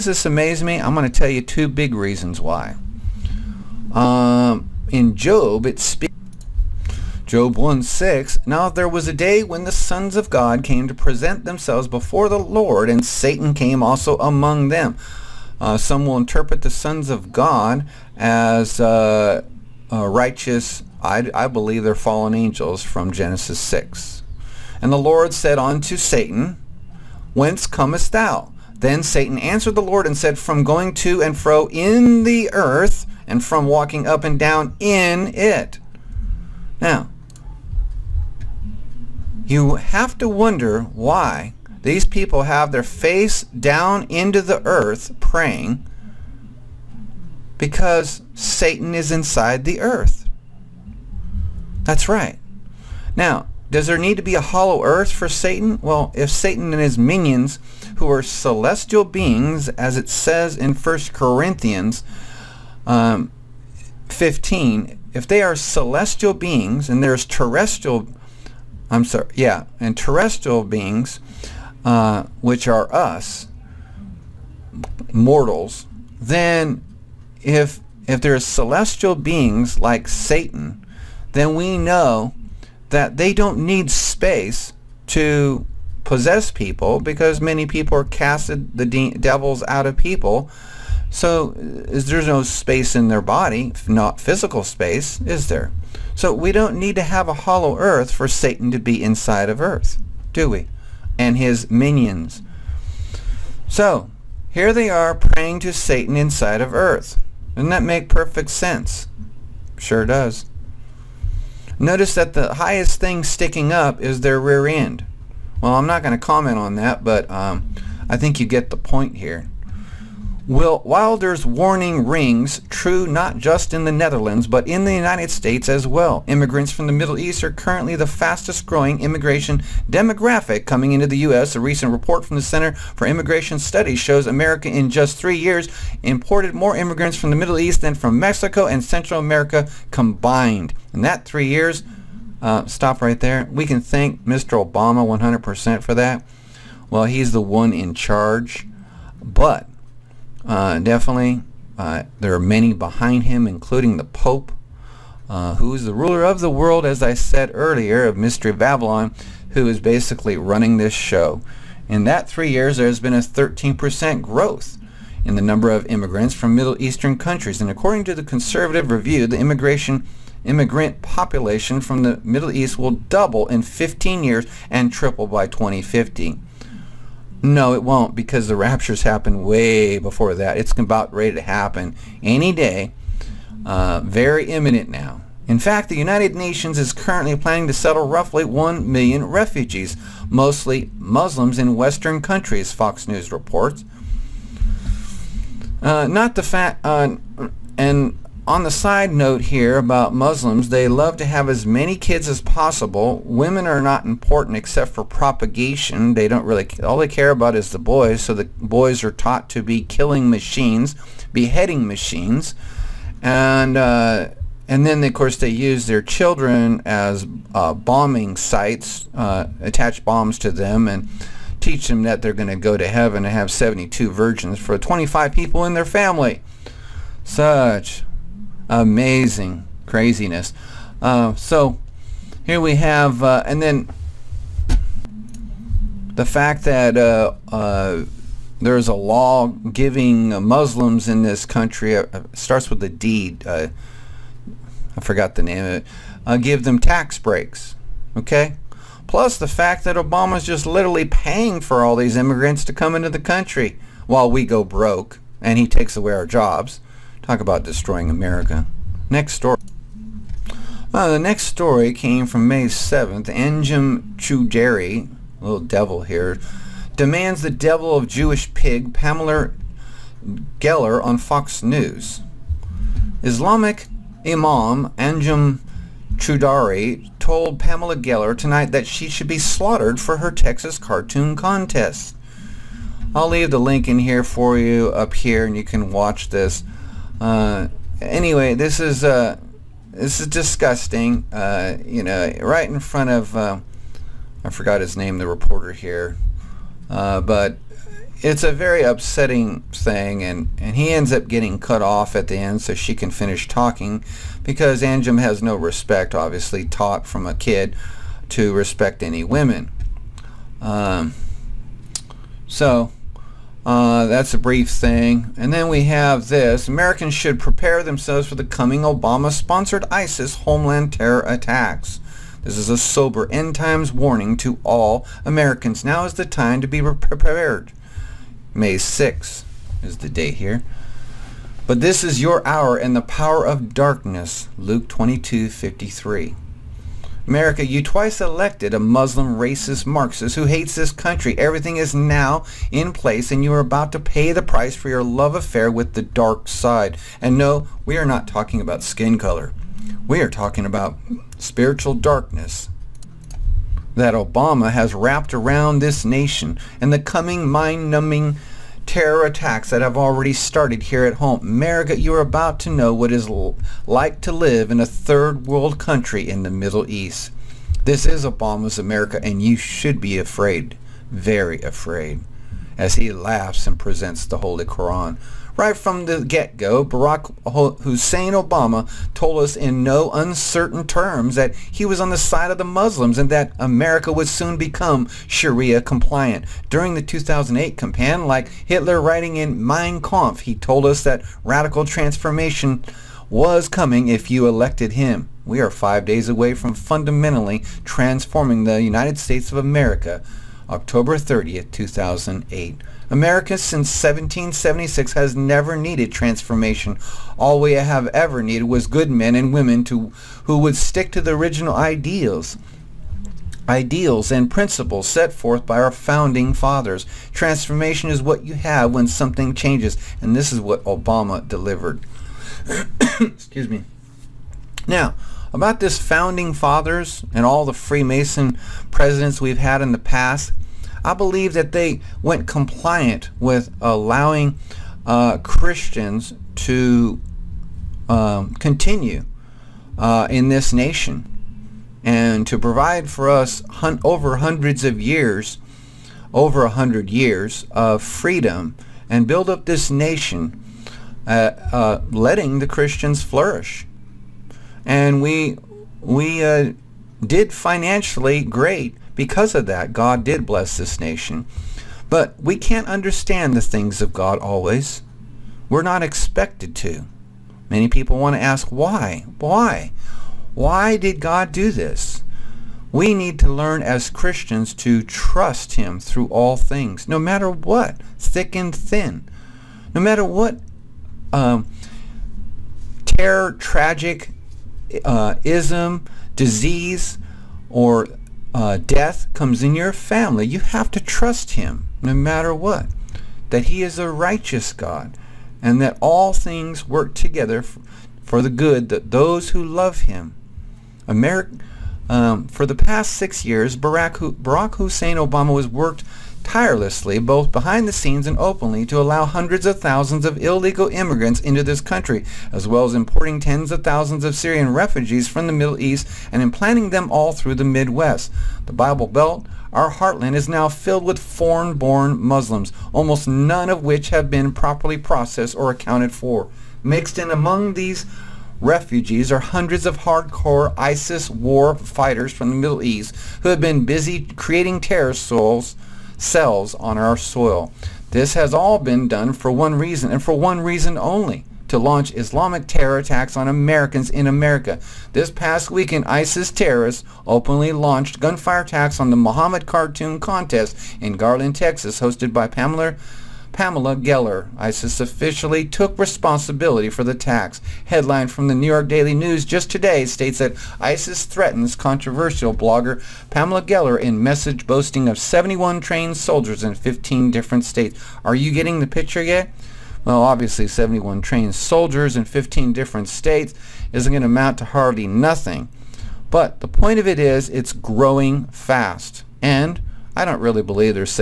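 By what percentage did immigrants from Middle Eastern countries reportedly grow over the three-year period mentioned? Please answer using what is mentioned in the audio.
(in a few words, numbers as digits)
13%.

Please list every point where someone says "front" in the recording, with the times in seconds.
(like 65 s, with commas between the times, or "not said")
292 s.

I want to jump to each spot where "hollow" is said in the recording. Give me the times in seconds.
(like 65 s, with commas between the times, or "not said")
54 s, 97 s.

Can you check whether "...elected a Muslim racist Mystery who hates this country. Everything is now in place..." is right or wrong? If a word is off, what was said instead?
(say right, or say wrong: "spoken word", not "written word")
wrong: "Marxist", not "Mystery".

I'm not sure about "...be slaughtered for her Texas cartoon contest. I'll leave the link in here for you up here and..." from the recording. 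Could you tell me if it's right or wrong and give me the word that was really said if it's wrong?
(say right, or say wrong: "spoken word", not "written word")
right.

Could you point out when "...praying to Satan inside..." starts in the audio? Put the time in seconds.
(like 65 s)
105 s.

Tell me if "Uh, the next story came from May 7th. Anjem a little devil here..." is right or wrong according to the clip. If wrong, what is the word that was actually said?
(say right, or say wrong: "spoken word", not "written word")
right.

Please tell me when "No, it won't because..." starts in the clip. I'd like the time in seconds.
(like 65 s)
177 s.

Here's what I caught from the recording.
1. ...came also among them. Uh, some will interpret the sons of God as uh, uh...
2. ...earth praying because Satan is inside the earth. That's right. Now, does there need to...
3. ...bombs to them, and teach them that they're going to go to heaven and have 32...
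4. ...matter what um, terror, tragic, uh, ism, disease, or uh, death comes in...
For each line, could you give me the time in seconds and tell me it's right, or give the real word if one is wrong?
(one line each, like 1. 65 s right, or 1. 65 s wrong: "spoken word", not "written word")
1. 13 s right
2. 44 s right
3. 220 s wrong: "72", not "32"
4. 479 s right.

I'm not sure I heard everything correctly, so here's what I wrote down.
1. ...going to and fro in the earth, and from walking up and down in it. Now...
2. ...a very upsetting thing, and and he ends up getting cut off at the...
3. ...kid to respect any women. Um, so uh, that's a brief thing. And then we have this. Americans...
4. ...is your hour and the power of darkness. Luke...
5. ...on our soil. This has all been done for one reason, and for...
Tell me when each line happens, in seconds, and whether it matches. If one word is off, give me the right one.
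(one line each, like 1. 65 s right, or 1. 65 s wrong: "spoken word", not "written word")
1. 30 s right
2. 298 s right
3. 307 s right
4. 332 s right
5. 536 s right.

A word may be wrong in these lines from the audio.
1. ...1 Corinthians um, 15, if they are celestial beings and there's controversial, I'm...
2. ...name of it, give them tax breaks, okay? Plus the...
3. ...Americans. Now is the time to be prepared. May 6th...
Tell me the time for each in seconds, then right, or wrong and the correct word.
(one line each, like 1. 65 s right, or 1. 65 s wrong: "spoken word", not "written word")
1. 60 s wrong: "terrestrial", not "controversial"
2. 245 s right
3. 325 s right.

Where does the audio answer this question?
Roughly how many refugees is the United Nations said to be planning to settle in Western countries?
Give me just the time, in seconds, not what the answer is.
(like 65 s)
188 s.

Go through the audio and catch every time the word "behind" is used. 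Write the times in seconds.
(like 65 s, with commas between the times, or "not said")
152 s, 507 s.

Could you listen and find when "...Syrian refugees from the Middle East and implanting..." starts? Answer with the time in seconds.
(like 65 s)
514 s.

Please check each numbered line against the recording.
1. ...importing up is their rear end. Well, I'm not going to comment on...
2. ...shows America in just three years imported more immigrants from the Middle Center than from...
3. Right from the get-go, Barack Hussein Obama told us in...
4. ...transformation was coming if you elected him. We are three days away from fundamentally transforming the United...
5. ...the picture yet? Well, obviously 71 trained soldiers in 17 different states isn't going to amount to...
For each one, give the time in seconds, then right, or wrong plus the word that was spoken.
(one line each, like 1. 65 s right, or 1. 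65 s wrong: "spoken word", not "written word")
1. 113 s wrong: "sticking", not "importing"
2. 133 s wrong: "East", not "Center"
3. 375 s right
4. 391 s wrong: "five", not "three"
5. 568 s wrong: "15", not "17".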